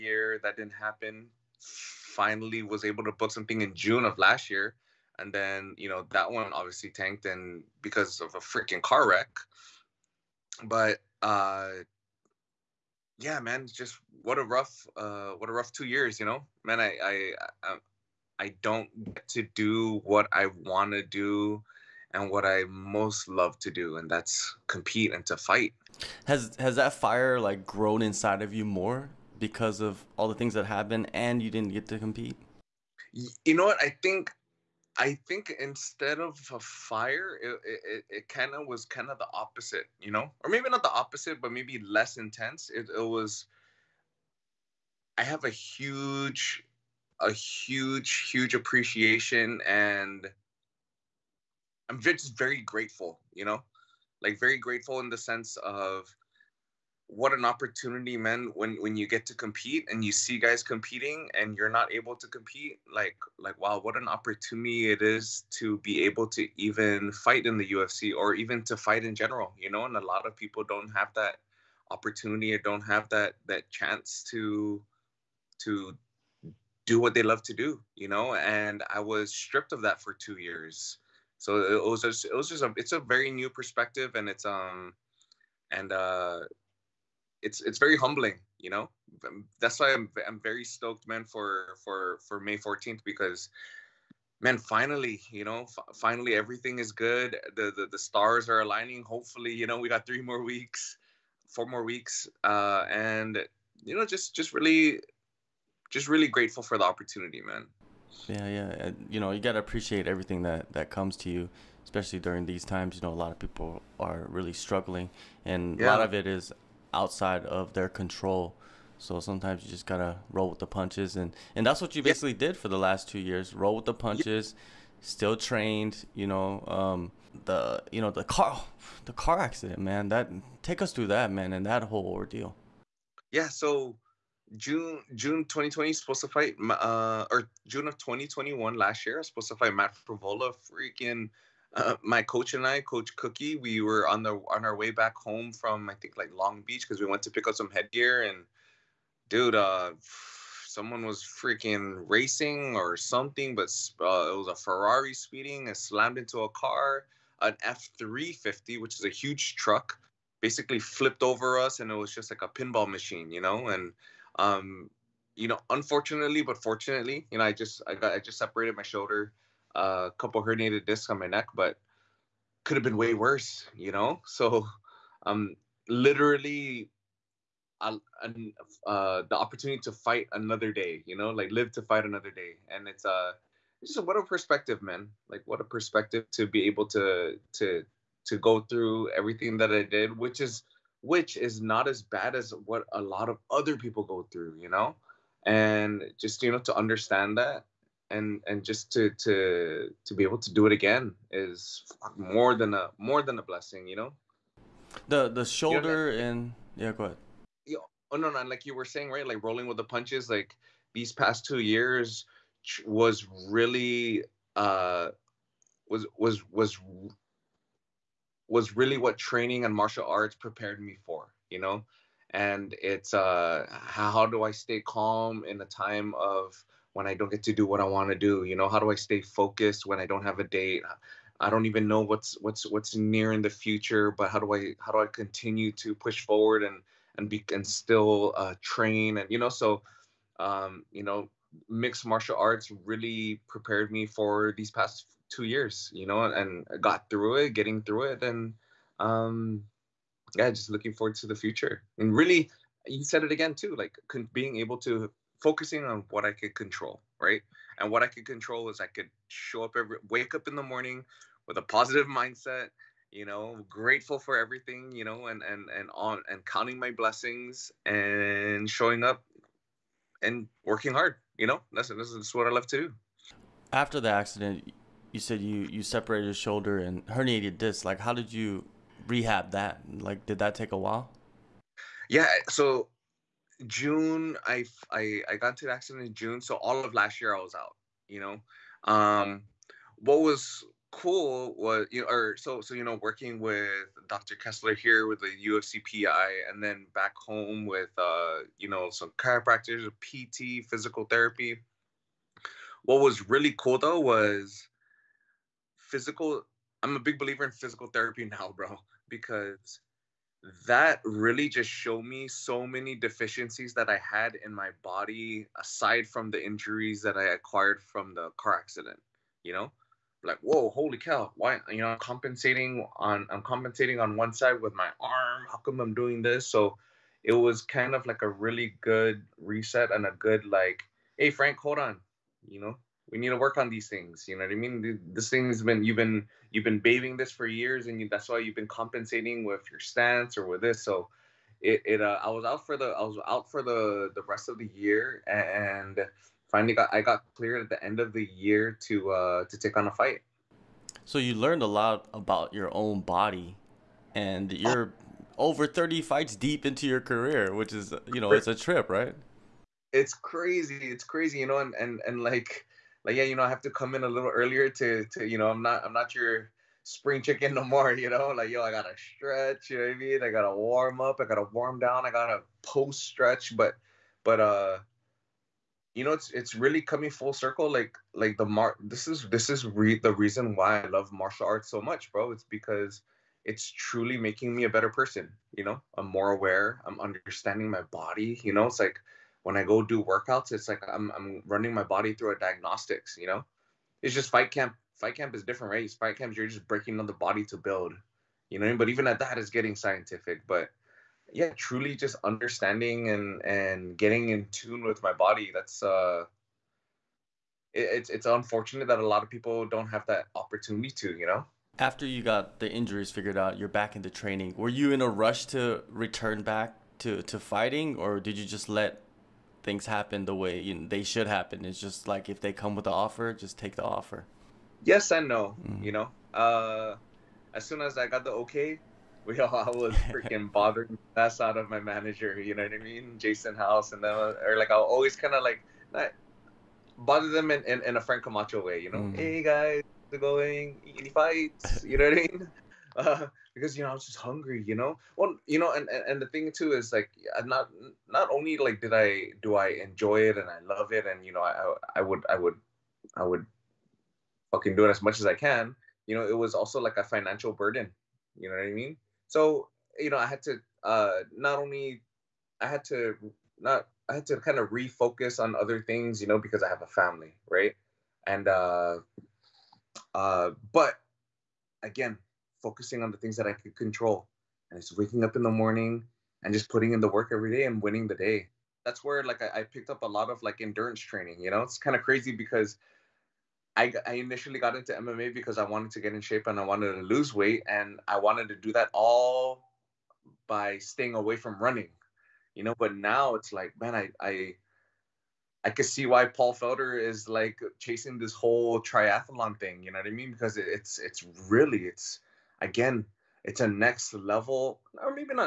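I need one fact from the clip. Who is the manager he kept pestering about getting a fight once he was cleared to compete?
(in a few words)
Jason House.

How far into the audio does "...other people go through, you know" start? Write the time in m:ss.
3:13.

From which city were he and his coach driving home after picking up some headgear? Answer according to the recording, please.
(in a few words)
Long Beach.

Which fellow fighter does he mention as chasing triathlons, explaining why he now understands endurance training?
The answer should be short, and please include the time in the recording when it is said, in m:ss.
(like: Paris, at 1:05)
Paul Felder, at 8:16.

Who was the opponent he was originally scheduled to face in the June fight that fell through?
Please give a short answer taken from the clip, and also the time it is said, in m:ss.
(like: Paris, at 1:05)
Matt Frevola, at 2:19.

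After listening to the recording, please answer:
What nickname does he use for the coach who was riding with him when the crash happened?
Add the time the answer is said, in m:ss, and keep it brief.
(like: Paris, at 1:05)
Cookie, at 2:23.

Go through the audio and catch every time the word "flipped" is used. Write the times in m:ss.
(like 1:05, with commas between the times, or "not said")
2:40.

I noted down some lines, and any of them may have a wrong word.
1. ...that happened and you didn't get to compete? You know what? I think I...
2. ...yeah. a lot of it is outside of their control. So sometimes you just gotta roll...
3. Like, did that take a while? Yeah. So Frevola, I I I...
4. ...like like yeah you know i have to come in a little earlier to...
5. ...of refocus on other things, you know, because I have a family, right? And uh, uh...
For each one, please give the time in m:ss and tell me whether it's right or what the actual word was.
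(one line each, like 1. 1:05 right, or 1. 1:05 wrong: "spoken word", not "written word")
1. 0:30 right
2. 1:55 right
3. 4:39 wrong: "June", not "Frevola"
4. 6:02 right
5. 7:44 right.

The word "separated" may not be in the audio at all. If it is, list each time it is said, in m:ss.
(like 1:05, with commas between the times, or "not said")
2:48, 4:35.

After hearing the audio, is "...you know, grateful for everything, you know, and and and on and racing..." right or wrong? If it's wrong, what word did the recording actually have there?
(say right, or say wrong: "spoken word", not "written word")
wrong: "counting", not "racing".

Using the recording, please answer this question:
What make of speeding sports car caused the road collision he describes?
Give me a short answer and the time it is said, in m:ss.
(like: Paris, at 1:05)
Ferrari, at 2:34.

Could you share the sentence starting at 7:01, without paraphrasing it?
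It's just like if they come with the offer, just take the offer.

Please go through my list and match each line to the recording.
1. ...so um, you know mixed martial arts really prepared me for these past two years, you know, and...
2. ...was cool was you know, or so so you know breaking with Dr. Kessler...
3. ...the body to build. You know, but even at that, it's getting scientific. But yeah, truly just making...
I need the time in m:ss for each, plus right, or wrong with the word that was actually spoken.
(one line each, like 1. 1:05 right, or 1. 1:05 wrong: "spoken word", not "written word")
1. 3:59 right
2. 4:50 wrong: "working", not "breaking"
3. 6:37 wrong: "understanding", not "making".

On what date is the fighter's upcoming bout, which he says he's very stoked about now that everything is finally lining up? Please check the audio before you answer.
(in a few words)
May 14.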